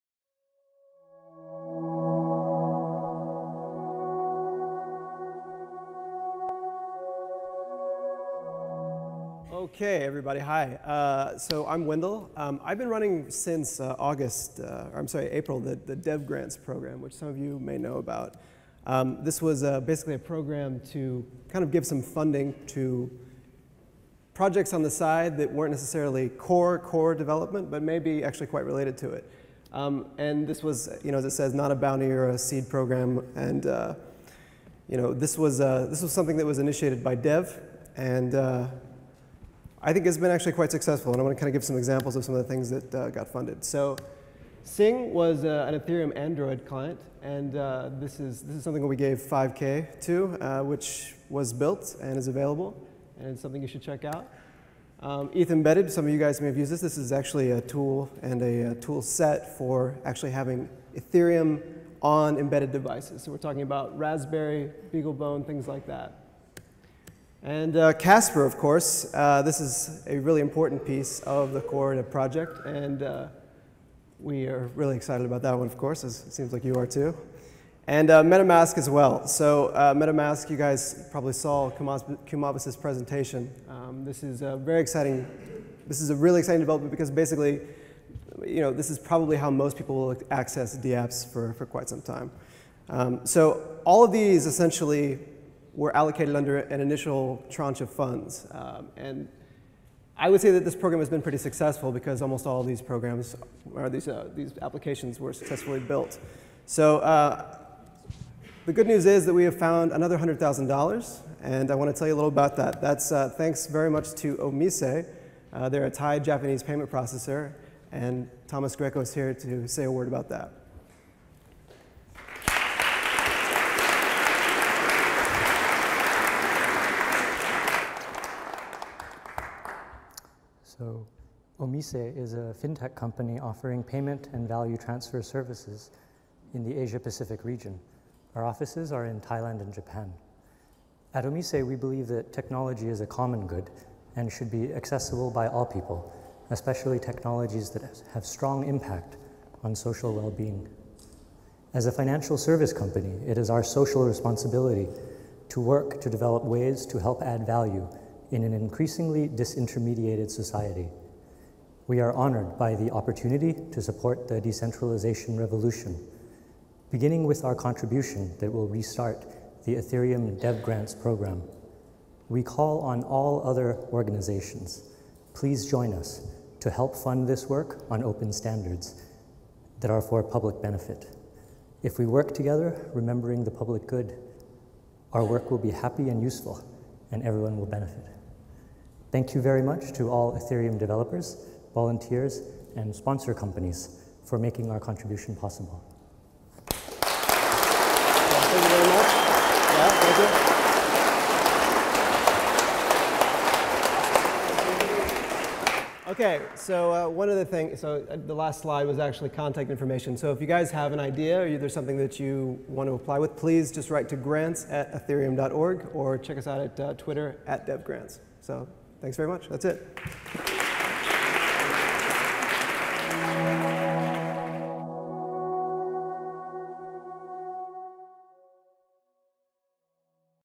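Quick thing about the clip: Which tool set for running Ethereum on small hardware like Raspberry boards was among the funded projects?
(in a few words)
ETH Embedded.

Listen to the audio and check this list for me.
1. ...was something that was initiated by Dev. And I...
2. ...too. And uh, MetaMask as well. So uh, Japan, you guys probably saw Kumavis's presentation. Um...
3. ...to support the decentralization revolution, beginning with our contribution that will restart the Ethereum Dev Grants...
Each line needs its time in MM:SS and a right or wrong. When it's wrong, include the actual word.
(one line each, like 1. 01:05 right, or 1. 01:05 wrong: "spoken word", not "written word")
1. 00:36 right
2. 01:16 wrong: "MetaMask", not "Japan"
3. 02:43 right.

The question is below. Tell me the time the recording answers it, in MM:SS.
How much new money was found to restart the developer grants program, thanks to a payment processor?
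01:50.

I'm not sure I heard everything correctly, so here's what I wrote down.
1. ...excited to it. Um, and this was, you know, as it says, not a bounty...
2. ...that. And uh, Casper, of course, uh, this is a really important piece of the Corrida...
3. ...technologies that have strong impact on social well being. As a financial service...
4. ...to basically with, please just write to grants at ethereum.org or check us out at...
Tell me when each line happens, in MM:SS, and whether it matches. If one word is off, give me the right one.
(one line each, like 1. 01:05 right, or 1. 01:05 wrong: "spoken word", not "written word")
1. 00:28 wrong: "related", not "excited"
2. 01:05 right
3. 02:26 right
4. 03:32 wrong: "apply", not "basically".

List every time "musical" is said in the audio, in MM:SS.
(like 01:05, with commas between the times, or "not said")
not said.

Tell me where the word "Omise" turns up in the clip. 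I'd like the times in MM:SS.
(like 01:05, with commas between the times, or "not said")
01:54, 02:11, 02:21.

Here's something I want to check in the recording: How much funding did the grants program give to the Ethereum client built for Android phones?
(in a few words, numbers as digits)
5K.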